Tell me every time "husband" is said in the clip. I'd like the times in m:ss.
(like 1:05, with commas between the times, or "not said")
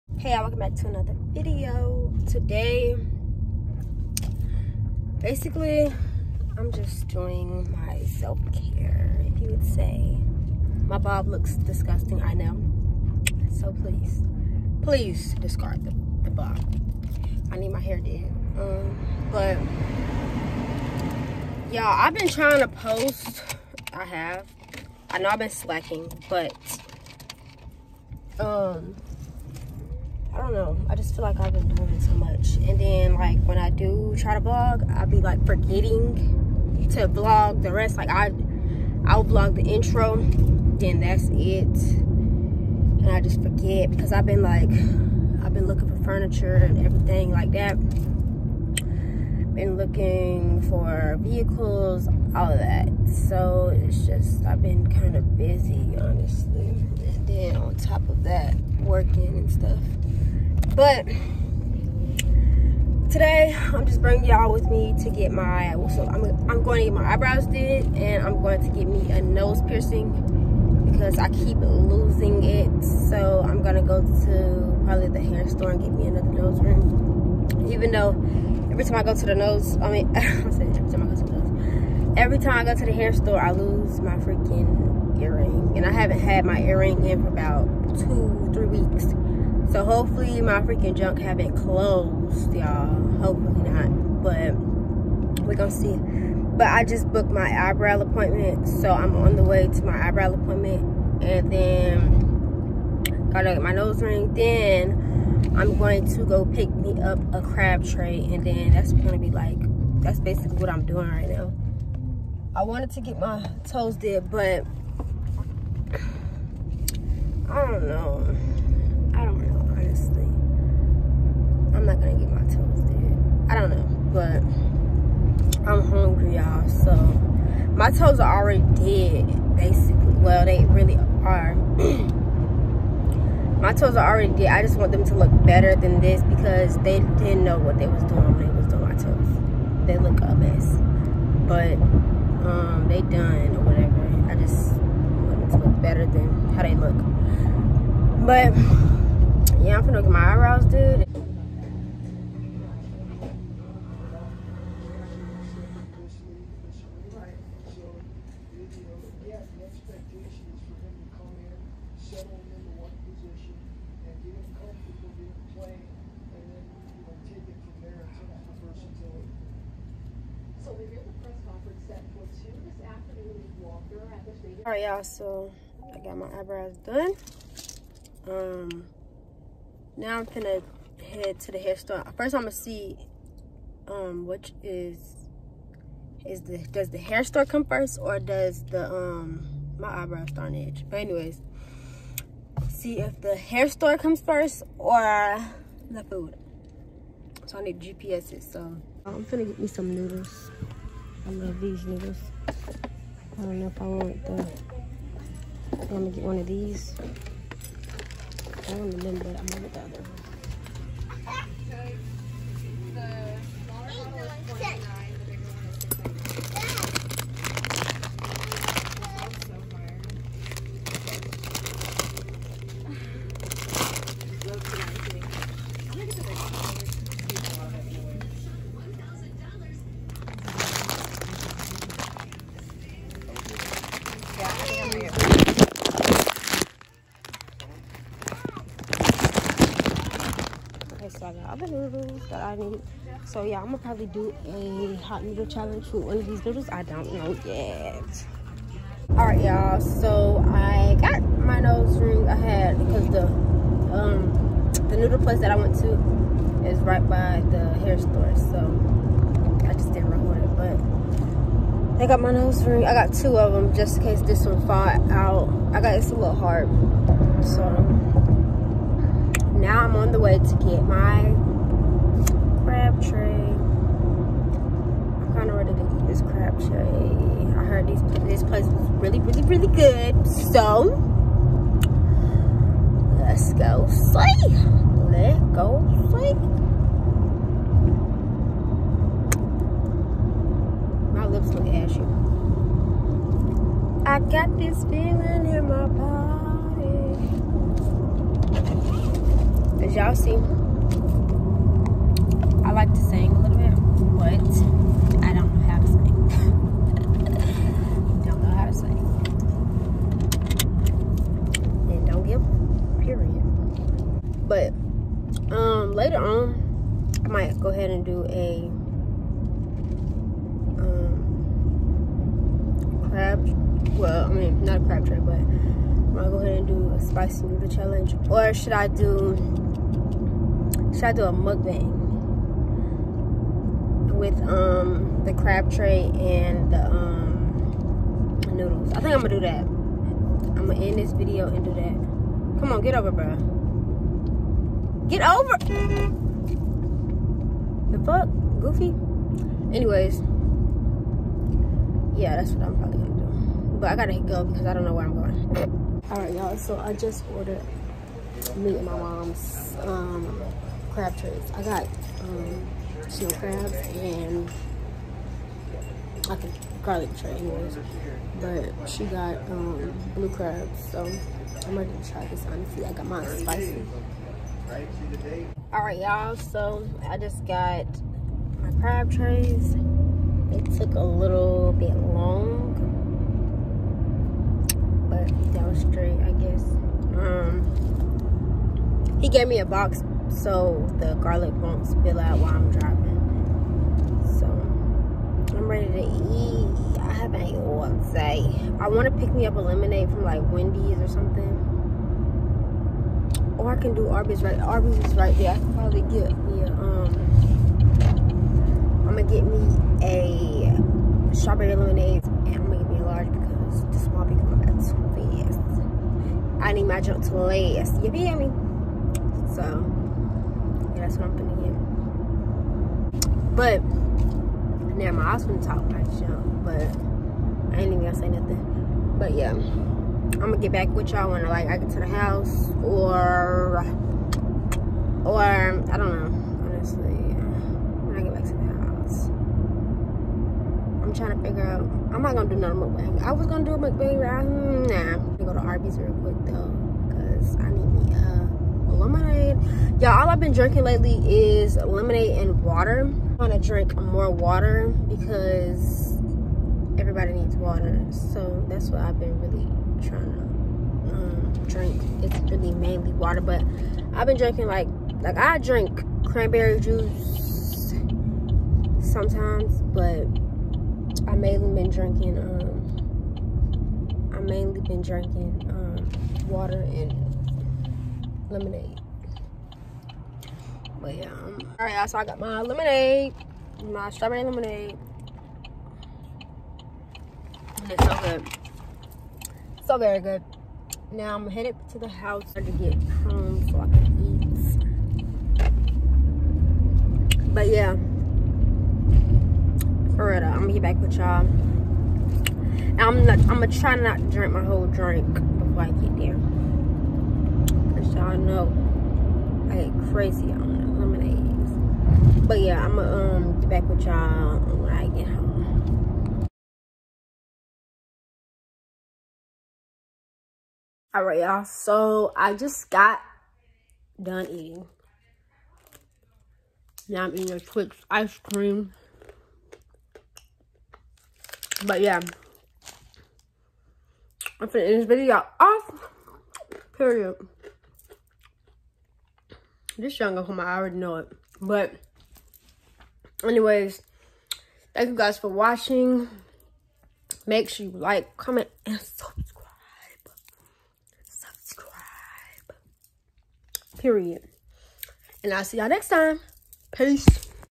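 7:05.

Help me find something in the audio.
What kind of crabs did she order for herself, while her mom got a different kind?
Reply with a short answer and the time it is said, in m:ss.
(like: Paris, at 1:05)
snow crabs, at 6:03.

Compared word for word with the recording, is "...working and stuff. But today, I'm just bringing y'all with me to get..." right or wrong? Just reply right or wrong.
right.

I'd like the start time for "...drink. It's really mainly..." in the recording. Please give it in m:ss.
7:41.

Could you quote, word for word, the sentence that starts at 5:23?
Well, I mean, not a crab tray, but I'm gonna go ahead and do a spicy noodle challenge.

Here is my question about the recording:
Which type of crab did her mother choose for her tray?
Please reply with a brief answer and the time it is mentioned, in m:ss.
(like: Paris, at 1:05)
blue crabs, at 6:10.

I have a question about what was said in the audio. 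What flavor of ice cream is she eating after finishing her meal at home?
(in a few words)
Twix.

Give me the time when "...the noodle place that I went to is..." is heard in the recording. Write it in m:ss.
4:14.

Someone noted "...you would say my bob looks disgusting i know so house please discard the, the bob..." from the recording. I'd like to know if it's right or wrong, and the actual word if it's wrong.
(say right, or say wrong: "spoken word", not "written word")
wrong: "please", not "house".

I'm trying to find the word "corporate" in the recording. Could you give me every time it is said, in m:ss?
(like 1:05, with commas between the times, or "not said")
not said.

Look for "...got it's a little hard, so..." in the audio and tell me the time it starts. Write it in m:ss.
4:25.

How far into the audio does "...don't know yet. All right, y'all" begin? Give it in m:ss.
4:06.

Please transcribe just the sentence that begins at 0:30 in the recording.
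I just feel like I've been doing it so much.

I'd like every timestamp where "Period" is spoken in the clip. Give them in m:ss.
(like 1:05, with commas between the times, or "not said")
8:56, 9:14.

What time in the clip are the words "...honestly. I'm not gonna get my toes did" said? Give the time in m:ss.
1:59.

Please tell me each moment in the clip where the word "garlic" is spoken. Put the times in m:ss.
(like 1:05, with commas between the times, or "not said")
6:06, 6:31.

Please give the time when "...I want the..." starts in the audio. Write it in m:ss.
3:23.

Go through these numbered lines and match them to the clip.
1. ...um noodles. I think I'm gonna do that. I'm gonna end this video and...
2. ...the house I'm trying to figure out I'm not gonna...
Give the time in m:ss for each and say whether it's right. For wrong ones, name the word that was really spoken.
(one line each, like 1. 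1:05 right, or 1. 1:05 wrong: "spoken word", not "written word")
1. 5:36 right
2. 7:18 right.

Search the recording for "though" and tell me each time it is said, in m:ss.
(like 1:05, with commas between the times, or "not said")
1:17, 7:26.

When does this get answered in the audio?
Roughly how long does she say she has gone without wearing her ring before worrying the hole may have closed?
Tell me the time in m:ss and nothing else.
1:27.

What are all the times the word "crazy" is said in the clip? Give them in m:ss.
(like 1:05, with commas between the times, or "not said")
8:30.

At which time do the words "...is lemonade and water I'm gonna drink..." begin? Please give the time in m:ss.
7:31.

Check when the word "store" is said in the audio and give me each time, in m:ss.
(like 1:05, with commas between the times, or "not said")
1:15, 1:23, 3:01, 3:07, 3:13, 4:17.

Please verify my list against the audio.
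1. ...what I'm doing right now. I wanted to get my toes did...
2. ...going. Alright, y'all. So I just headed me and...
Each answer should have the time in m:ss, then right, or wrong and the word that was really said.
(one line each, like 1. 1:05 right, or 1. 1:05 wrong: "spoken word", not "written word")
1. 1:50 right
2. 5:55 wrong: "ordered", not "headed".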